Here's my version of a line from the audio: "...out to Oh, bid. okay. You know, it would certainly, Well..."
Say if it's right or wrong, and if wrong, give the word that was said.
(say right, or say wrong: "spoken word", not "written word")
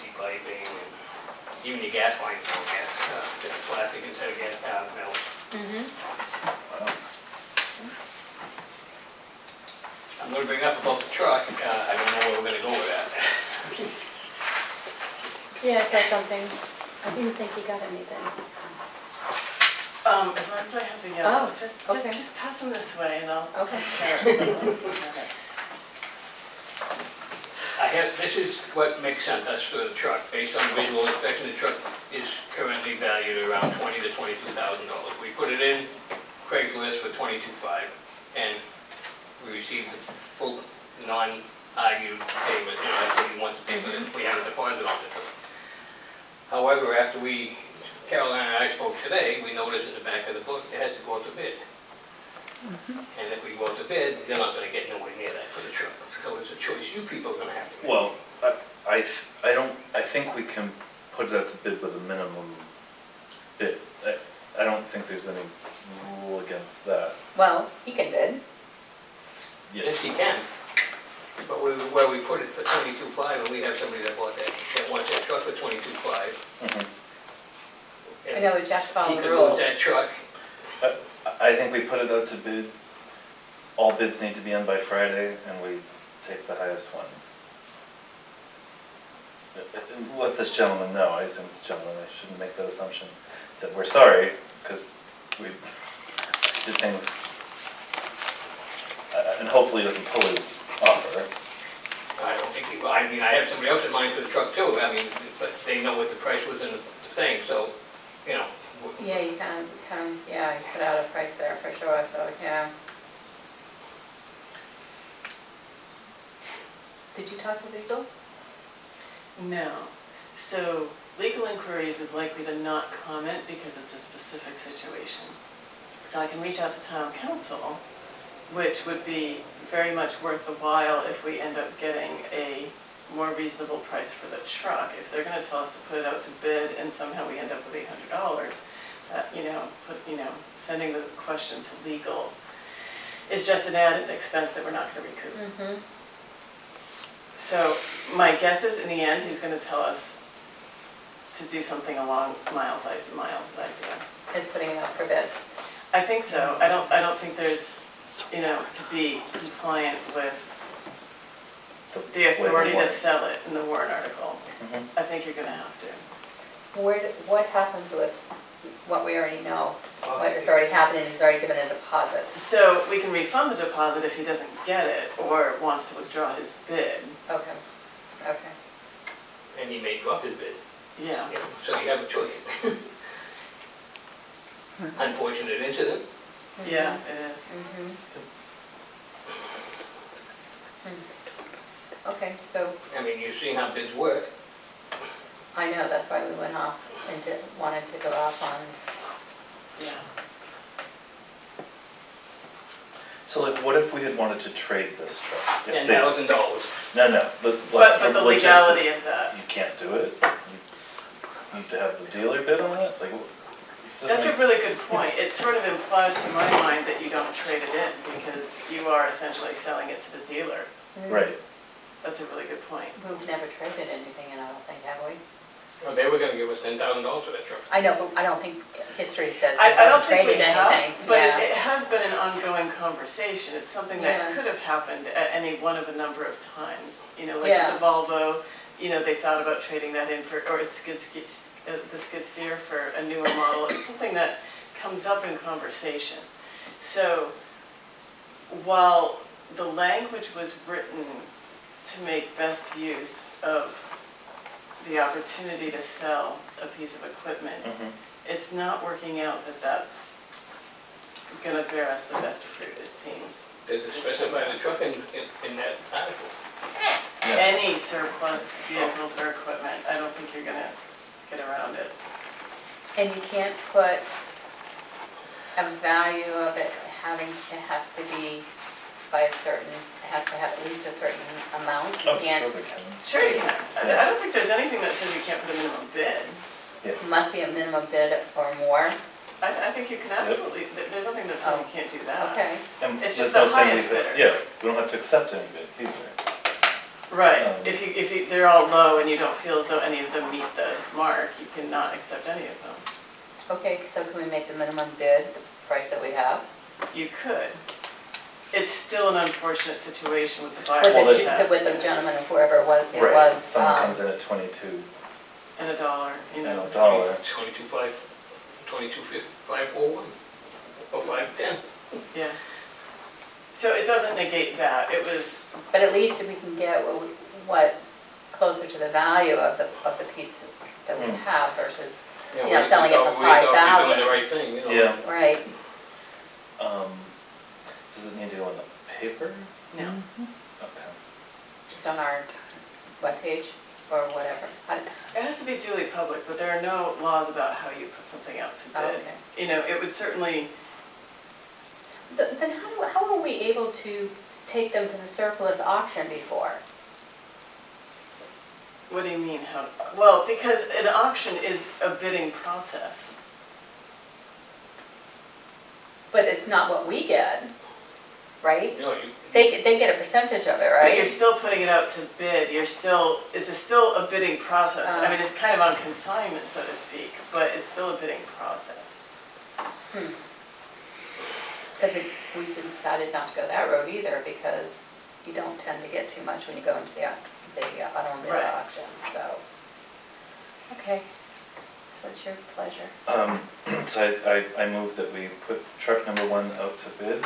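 wrong: "Then", not "Well".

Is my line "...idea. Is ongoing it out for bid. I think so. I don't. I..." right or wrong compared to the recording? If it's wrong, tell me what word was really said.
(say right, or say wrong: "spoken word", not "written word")
wrong: "putting", not "ongoing".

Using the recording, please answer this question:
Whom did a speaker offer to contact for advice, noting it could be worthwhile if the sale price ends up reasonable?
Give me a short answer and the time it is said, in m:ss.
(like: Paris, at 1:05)
town counsel, at 2:06.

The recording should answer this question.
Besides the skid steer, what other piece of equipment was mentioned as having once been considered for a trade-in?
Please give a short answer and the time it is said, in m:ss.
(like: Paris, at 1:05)
the Volvo, at 3:57.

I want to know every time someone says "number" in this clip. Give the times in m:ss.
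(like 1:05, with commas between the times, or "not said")
3:55, 6:36.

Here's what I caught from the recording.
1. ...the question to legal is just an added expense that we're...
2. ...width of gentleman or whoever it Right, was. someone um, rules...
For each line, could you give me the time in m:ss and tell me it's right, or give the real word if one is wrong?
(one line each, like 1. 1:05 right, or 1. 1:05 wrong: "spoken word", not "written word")
1. 2:20 right
2. 5:11 wrong: "comes", not "rules".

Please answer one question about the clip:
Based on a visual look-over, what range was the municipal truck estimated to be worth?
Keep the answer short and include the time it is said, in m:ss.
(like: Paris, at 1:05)
$20,000 to $22,000, at 0:33.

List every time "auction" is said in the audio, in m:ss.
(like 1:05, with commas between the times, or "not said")
5:55, 6:00, 6:28.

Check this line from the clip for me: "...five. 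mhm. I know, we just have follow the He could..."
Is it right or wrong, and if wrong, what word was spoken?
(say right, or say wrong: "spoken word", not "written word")
right.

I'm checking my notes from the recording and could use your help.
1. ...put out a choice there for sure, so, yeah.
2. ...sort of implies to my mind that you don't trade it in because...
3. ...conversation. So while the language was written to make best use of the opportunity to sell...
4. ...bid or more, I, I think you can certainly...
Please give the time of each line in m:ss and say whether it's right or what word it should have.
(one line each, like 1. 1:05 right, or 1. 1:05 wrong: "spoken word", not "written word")
1. 1:50 wrong: "price", not "choice"
2. 3:35 right
3. 4:05 right
4. 4:47 wrong: "absolutely", not "certainly".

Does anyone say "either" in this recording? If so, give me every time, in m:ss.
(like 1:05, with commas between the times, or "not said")
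4:55, 6:23.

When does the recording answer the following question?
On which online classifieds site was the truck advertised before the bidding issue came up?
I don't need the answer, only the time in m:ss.
0:36.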